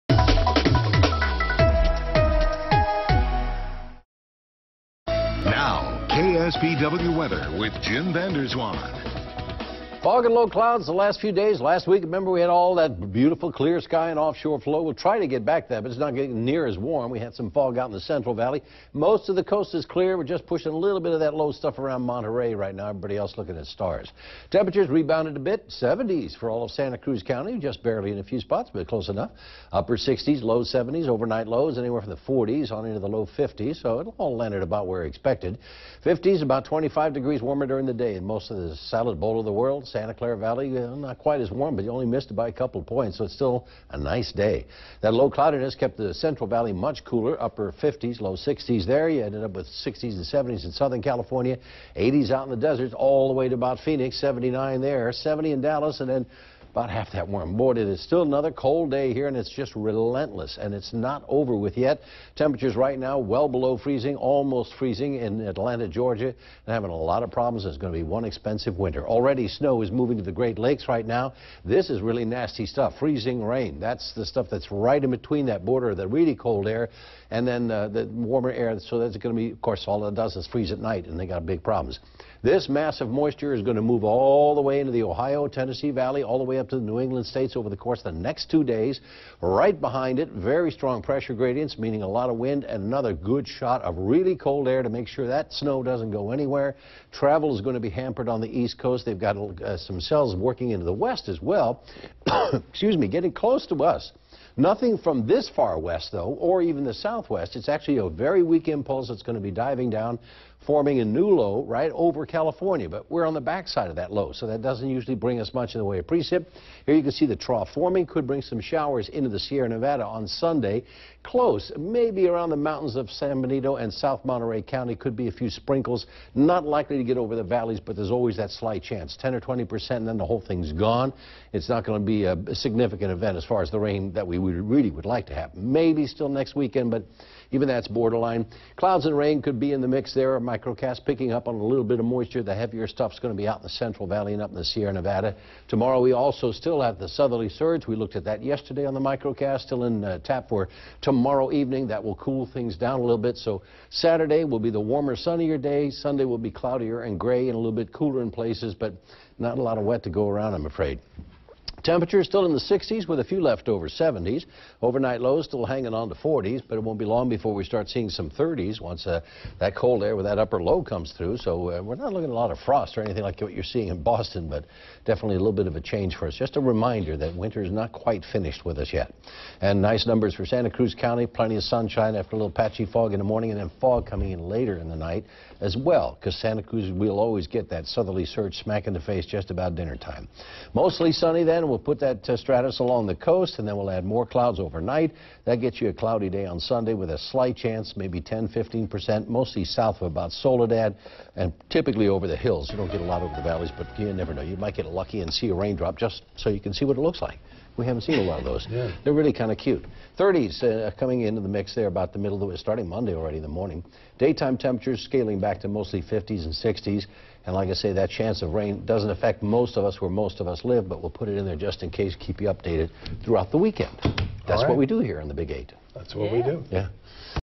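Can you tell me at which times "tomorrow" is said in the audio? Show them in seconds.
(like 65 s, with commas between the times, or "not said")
145 s, 151 s.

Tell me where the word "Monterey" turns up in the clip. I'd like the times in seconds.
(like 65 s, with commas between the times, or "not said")
22 s, 124 s.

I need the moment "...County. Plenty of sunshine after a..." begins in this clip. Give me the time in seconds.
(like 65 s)
180 s.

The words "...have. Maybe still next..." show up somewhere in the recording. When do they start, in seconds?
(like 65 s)
135 s.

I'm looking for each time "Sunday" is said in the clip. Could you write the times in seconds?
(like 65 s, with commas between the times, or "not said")
120 s, 155 s, 196 s.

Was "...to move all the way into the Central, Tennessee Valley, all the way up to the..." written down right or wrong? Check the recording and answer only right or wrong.
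wrong.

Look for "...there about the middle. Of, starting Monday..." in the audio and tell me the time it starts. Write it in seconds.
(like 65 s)
211 s.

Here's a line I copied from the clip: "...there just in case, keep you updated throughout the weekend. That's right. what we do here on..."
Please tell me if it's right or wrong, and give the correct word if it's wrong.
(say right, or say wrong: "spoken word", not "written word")
right.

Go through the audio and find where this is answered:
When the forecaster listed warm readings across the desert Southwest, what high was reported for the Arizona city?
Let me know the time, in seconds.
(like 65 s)
54 s.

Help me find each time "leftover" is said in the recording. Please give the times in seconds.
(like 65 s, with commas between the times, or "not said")
163 s.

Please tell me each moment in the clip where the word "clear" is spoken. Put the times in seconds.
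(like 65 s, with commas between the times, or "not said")
13 s, 19 s.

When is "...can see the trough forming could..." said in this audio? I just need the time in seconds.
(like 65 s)
117 s.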